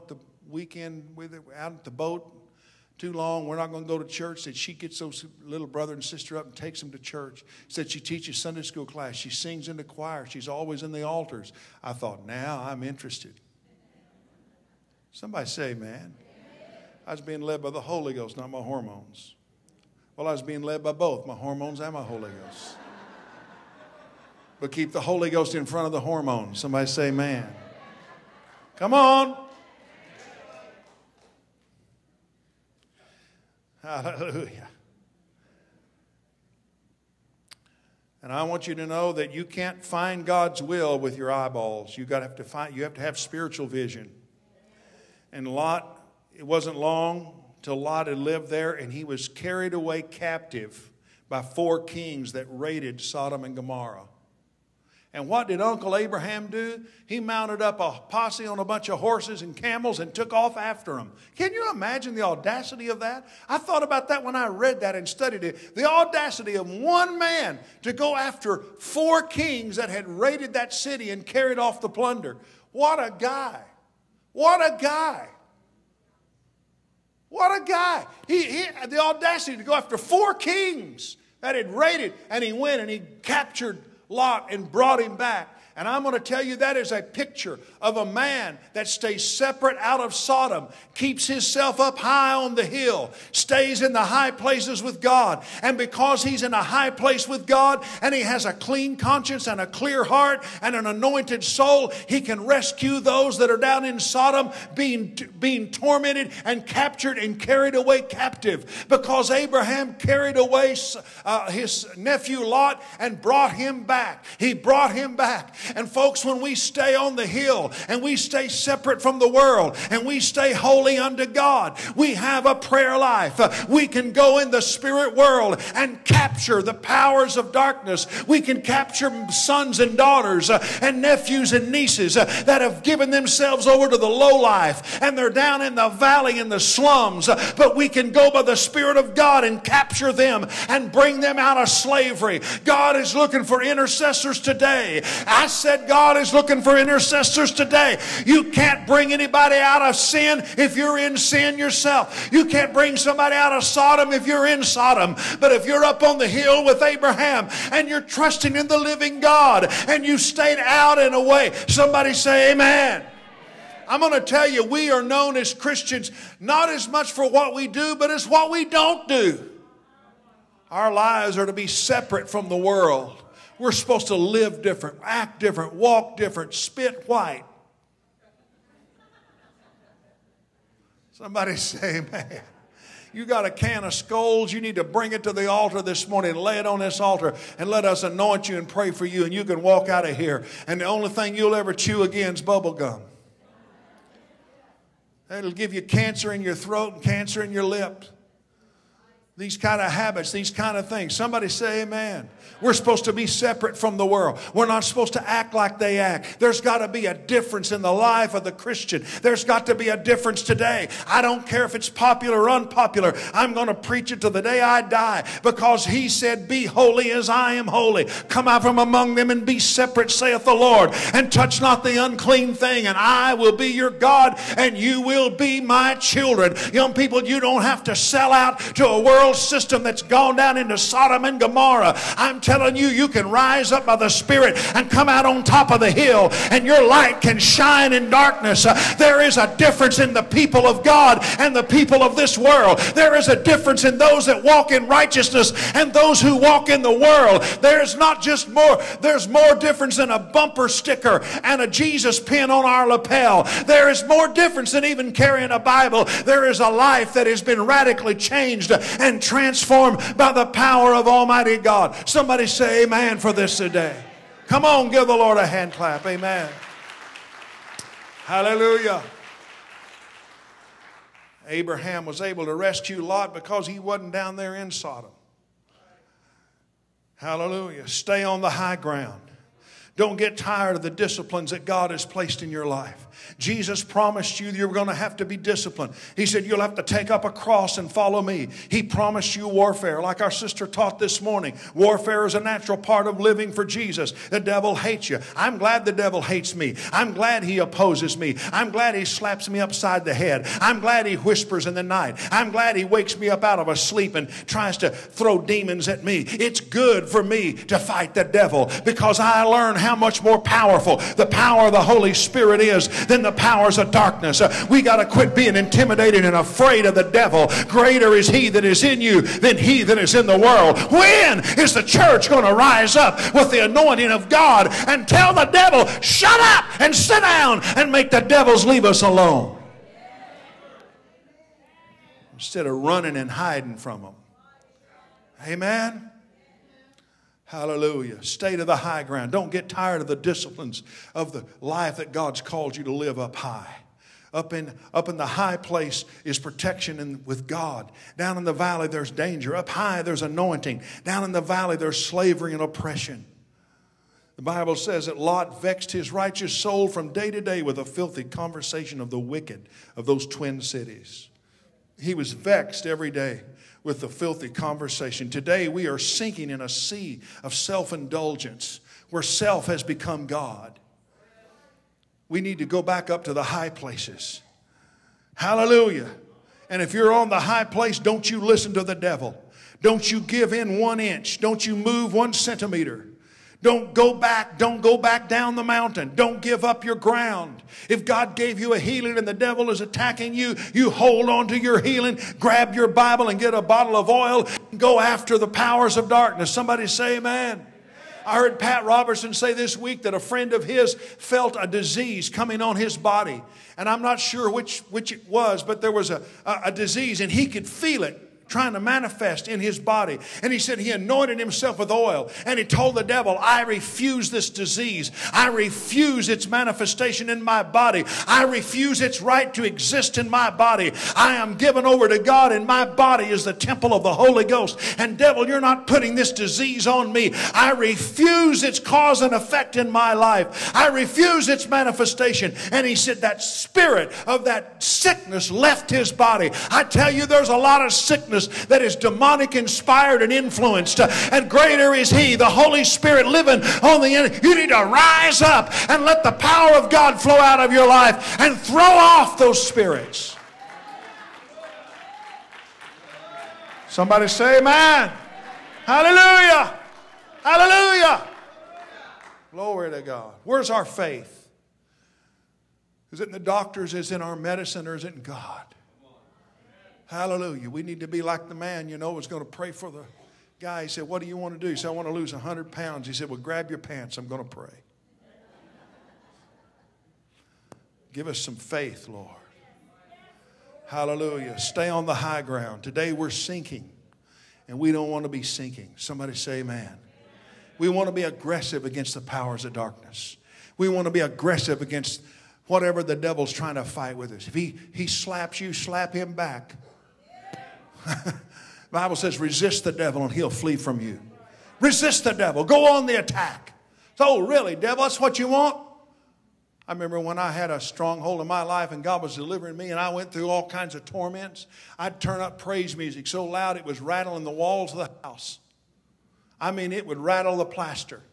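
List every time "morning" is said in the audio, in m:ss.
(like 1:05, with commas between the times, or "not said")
3:06, 4:51.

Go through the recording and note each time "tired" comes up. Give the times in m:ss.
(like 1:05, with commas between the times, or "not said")
4:40, 5:39.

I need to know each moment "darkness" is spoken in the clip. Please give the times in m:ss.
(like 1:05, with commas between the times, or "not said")
2:07, 3:58, 5:13, 6:36, 8:09.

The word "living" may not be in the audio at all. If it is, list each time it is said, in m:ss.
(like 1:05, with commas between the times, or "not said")
2:38, 4:53, 7:23.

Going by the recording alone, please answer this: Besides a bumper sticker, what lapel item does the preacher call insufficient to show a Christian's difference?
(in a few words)
Jesus pin.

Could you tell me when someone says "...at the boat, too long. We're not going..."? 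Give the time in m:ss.
0:01.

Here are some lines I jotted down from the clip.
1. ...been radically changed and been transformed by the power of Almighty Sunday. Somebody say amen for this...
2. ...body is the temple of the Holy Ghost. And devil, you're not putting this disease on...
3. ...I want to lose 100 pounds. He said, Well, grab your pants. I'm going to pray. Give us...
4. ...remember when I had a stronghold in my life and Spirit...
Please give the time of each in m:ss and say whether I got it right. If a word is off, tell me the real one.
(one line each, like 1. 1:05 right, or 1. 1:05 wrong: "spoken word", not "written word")
1. 4:17 wrong: "God", not "Sunday"
2. 7:02 right
3. 7:51 right
4. 8:26 wrong: "God", not "Spirit".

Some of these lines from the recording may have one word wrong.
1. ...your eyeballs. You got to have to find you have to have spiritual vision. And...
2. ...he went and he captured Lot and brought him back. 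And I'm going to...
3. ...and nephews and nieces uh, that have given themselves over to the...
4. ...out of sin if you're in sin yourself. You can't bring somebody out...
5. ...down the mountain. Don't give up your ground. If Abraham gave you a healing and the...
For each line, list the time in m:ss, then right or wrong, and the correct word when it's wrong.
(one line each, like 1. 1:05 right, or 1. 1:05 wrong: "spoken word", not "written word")
1. 0:41 right
2. 1:22 right
3. 2:10 right
4. 2:29 right
5. 6:25 wrong: "God", not "Abraham".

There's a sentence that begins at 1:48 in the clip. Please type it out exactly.
Because Abraham carried away uh, his nephew Lot and brought him back.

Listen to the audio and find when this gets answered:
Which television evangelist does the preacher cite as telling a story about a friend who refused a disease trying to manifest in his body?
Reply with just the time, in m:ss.
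6:38.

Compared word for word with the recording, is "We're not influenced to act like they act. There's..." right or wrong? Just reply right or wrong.
wrong.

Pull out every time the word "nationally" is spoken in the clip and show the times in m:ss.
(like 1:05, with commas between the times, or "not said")
not said.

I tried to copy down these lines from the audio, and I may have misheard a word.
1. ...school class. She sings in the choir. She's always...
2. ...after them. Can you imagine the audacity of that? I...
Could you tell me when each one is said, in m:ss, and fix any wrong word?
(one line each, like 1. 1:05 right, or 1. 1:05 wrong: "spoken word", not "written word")
1. 0:08 right
2. 1:00 right.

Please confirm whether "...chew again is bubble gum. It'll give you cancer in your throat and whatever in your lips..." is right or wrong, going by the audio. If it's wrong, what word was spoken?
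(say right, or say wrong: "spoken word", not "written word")
wrong: "cancer", not "whatever".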